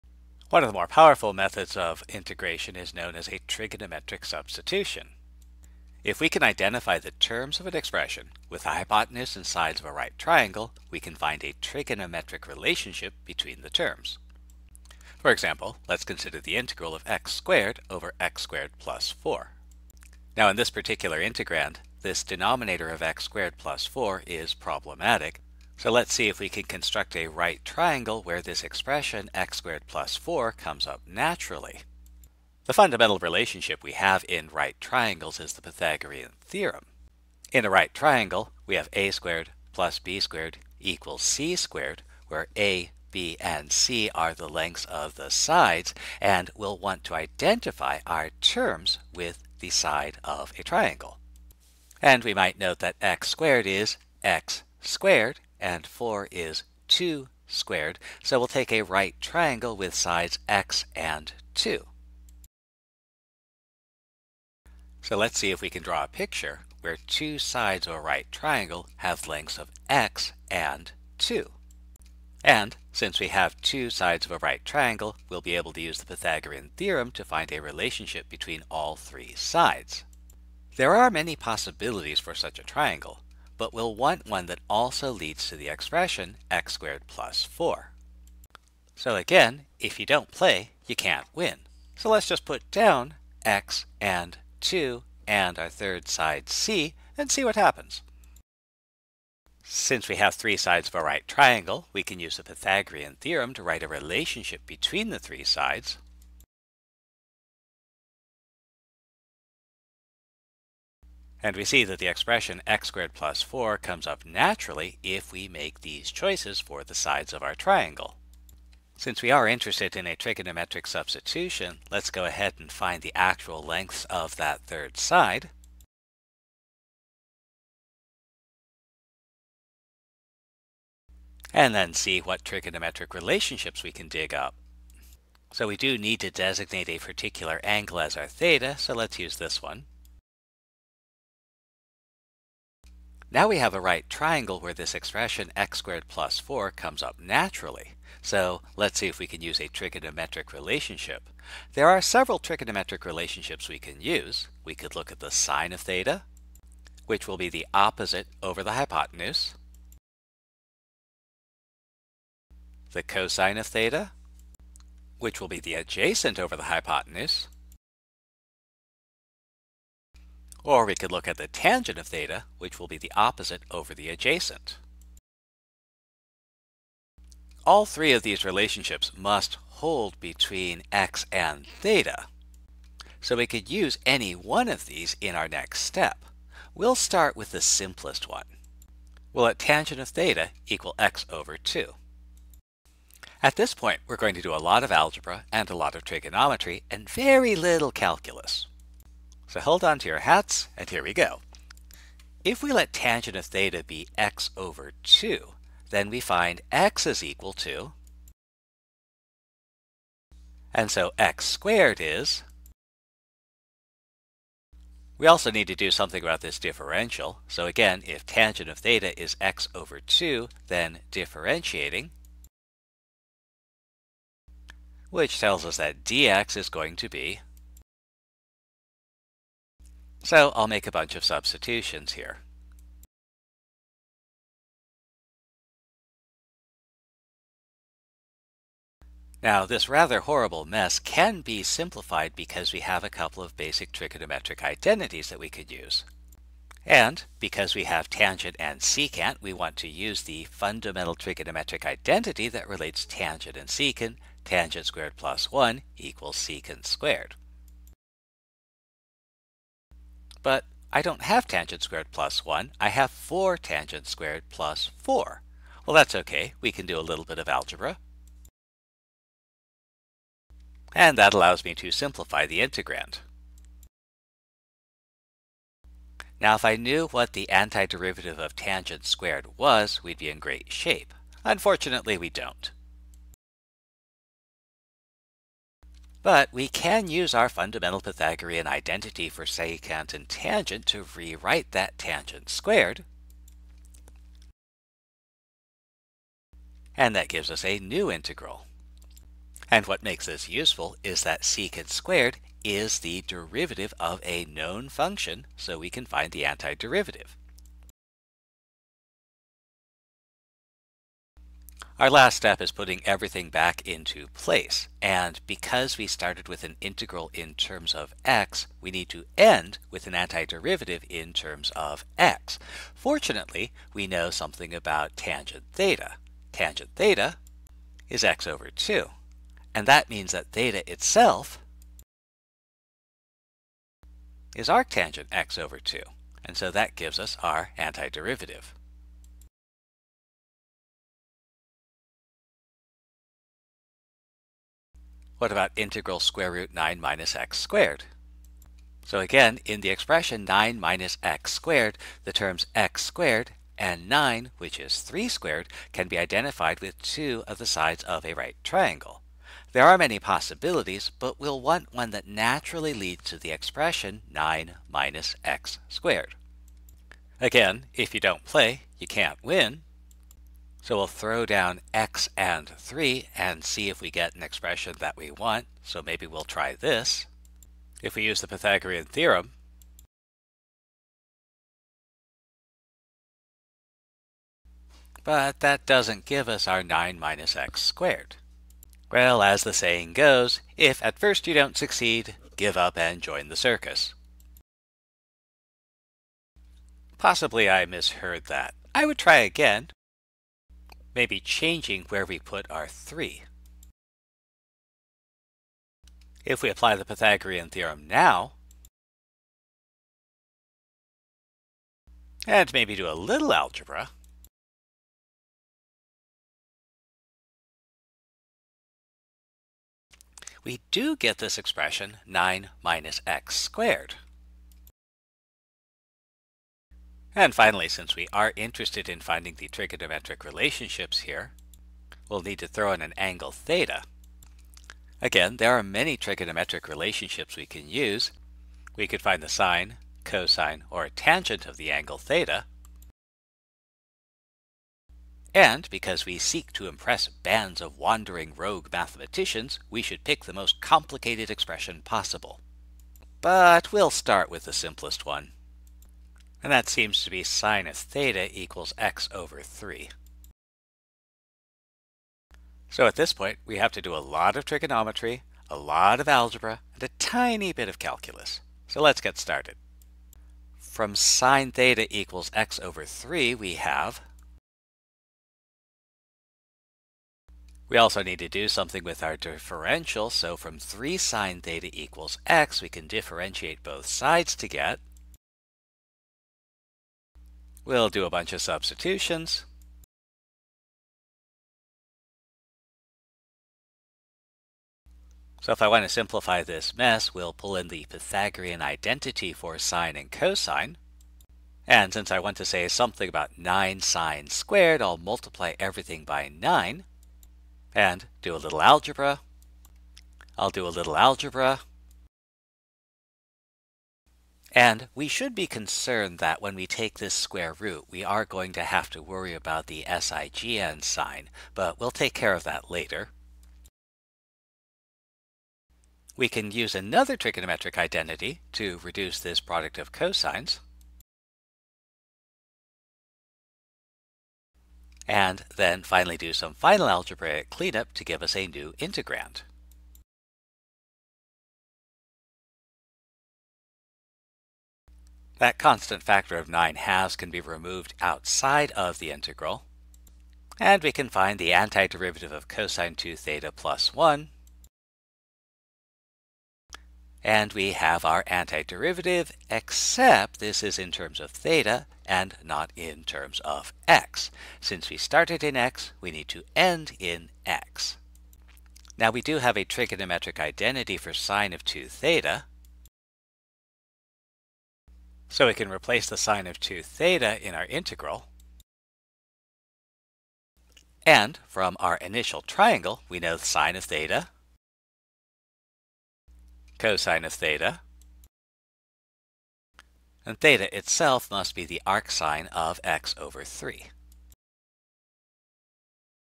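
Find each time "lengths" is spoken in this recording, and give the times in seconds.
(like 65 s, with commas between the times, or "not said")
44 s, 69 s, 123 s.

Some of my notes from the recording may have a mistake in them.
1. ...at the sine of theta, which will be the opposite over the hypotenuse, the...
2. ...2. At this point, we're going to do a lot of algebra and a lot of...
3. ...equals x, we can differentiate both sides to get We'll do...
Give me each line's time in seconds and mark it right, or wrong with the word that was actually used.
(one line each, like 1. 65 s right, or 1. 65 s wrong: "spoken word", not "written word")
1. 155 s right
2. 191 s right
3. 481 s right.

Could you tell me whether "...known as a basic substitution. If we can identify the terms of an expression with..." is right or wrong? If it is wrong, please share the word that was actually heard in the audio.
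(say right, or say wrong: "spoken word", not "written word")
wrong: "trigonometric", not "basic".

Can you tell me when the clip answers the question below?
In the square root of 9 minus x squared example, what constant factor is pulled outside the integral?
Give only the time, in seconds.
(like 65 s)
546 s.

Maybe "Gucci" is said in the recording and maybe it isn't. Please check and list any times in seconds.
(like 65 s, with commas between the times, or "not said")
not said.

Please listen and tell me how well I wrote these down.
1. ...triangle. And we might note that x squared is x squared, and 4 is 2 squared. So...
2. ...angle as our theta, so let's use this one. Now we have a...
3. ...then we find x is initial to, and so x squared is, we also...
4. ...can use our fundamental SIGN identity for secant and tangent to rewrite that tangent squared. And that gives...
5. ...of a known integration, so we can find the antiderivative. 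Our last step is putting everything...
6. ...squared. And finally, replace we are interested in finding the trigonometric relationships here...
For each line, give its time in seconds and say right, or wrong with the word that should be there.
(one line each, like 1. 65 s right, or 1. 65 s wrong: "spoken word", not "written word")
1. 50 s right
2. 137 s right
3. 205 s wrong: "equal", not "initial"
4. 286 s wrong: "Pythagorean", not "SIGN"
5. 303 s wrong: "function", not "integration"
6. 423 s wrong: "since", not "replace".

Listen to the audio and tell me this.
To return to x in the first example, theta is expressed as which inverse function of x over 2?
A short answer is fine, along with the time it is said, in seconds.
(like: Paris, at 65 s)
arctangent, at 334 s.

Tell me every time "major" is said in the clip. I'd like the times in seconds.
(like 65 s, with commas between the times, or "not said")
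not said.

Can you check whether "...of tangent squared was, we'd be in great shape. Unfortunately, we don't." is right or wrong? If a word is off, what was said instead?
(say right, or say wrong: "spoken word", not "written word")
right.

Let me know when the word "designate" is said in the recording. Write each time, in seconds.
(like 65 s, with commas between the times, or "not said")
136 s.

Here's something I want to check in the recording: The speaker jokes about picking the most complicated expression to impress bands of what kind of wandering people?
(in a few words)
rogue mathematicians.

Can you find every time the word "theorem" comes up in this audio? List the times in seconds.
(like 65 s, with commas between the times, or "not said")
36 s, 76 s, 103 s, 379 s, 407 s.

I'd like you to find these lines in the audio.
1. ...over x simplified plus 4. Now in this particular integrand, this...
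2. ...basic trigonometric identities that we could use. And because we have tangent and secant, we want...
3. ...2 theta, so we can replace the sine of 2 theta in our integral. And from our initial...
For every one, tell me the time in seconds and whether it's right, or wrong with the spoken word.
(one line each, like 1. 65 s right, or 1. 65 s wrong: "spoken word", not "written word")
1. 17 s wrong: "squared", not "simplified"
2. 243 s right
3. 571 s right.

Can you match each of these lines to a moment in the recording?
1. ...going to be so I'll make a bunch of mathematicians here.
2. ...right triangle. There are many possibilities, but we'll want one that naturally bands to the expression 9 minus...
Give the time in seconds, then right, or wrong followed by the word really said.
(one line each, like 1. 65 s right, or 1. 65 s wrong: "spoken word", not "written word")
1. 226 s wrong: "substitutions", not "mathematicians"
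2. 358 s wrong: "leads", not "bands".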